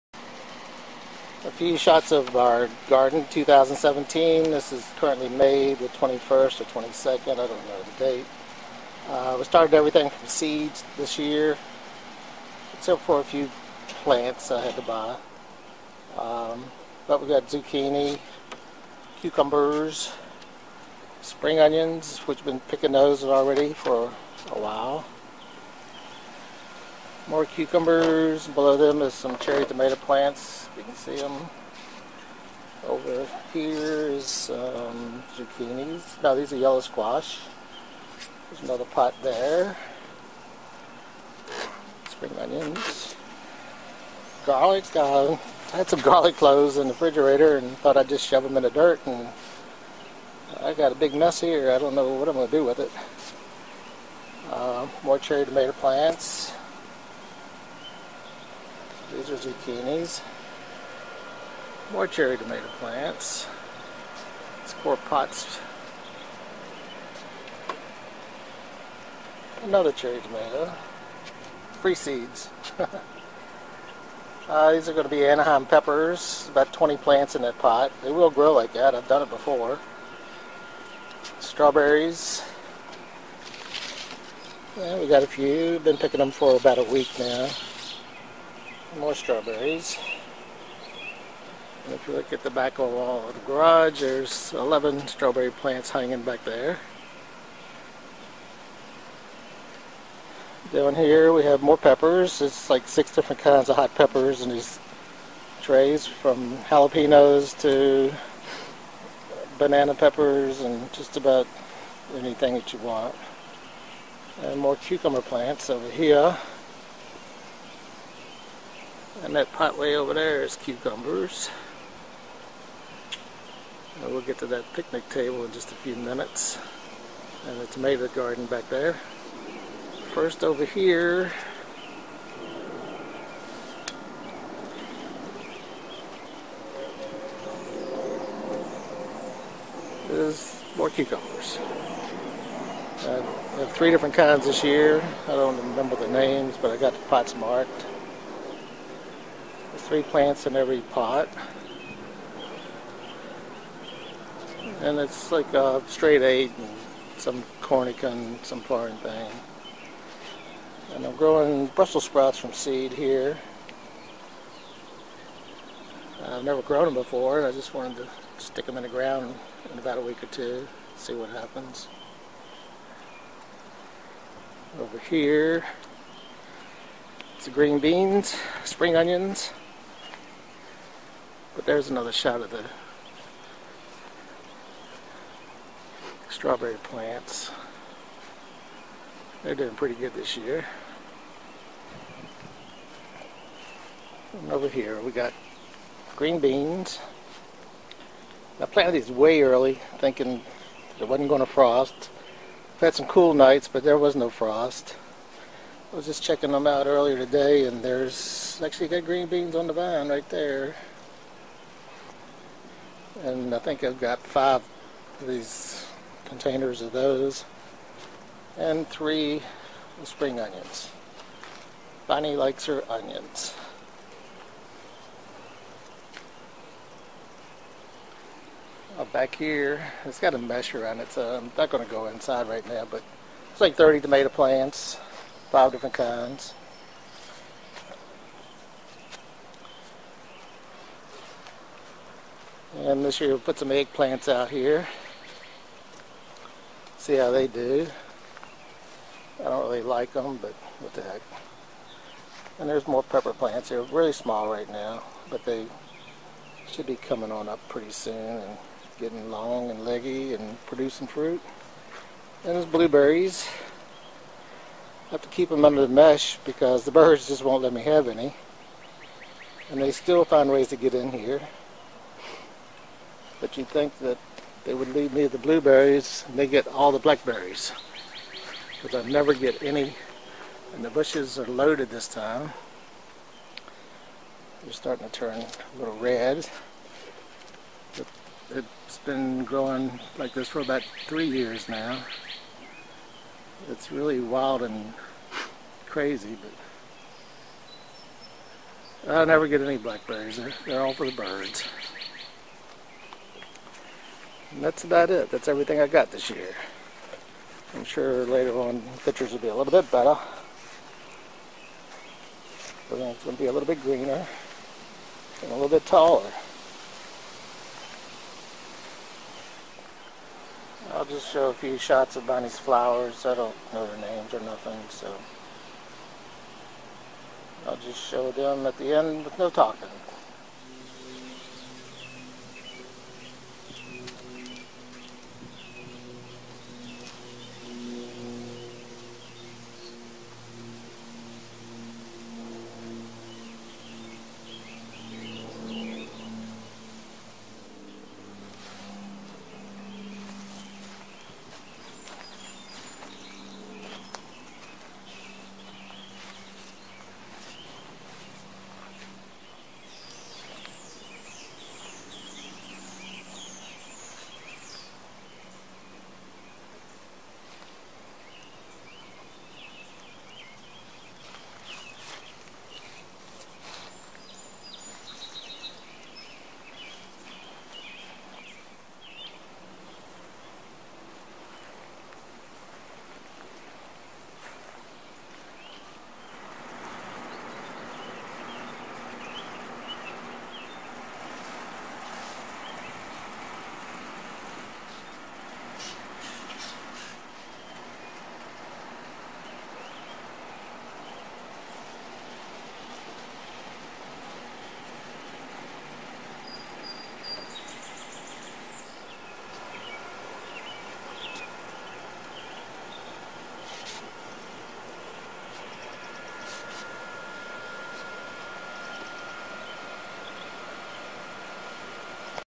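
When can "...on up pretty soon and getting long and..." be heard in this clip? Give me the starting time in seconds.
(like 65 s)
257 s.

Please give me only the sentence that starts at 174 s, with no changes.
Over here, it's the green beans, spring onions.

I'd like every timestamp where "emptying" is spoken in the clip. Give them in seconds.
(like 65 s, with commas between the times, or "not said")
not said.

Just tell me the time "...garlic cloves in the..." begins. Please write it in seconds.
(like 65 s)
46 s.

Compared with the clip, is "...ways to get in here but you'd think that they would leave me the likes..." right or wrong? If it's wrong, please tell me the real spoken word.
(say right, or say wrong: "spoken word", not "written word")
wrong: "blueberries", not "likes".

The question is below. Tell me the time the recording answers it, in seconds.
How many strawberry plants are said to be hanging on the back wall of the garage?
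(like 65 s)
94 s.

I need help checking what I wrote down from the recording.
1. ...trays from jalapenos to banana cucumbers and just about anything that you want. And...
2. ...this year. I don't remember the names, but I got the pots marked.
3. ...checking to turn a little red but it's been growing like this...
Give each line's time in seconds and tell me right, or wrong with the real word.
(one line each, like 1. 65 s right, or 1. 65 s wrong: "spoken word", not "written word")
1. 105 s wrong: "peppers", not "cucumbers"
2. 144 s right
3. 284 s wrong: "starting", not "checking".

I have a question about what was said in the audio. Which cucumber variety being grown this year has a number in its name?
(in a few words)
Straight eight.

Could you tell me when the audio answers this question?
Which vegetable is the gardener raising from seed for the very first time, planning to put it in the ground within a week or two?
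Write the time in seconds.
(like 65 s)
161 s.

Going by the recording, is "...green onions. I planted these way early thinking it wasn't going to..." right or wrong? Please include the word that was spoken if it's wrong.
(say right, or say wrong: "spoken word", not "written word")
wrong: "beans", not "onions".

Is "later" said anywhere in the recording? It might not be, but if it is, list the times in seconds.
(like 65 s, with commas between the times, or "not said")
308 s.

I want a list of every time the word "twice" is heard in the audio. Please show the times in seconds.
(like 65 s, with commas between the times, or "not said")
not said.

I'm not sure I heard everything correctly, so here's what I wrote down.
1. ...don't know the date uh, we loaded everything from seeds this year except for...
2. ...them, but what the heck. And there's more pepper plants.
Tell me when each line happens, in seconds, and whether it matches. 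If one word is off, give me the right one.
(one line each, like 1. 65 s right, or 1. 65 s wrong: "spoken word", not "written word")
1. 7 s wrong: "started", not "loaded"
2. 250 s right.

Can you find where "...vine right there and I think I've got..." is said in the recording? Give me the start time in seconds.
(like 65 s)
209 s.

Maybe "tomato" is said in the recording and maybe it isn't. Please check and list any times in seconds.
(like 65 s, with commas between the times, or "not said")
29 s, 55 s, 62 s, 70 s, 127 s, 234 s.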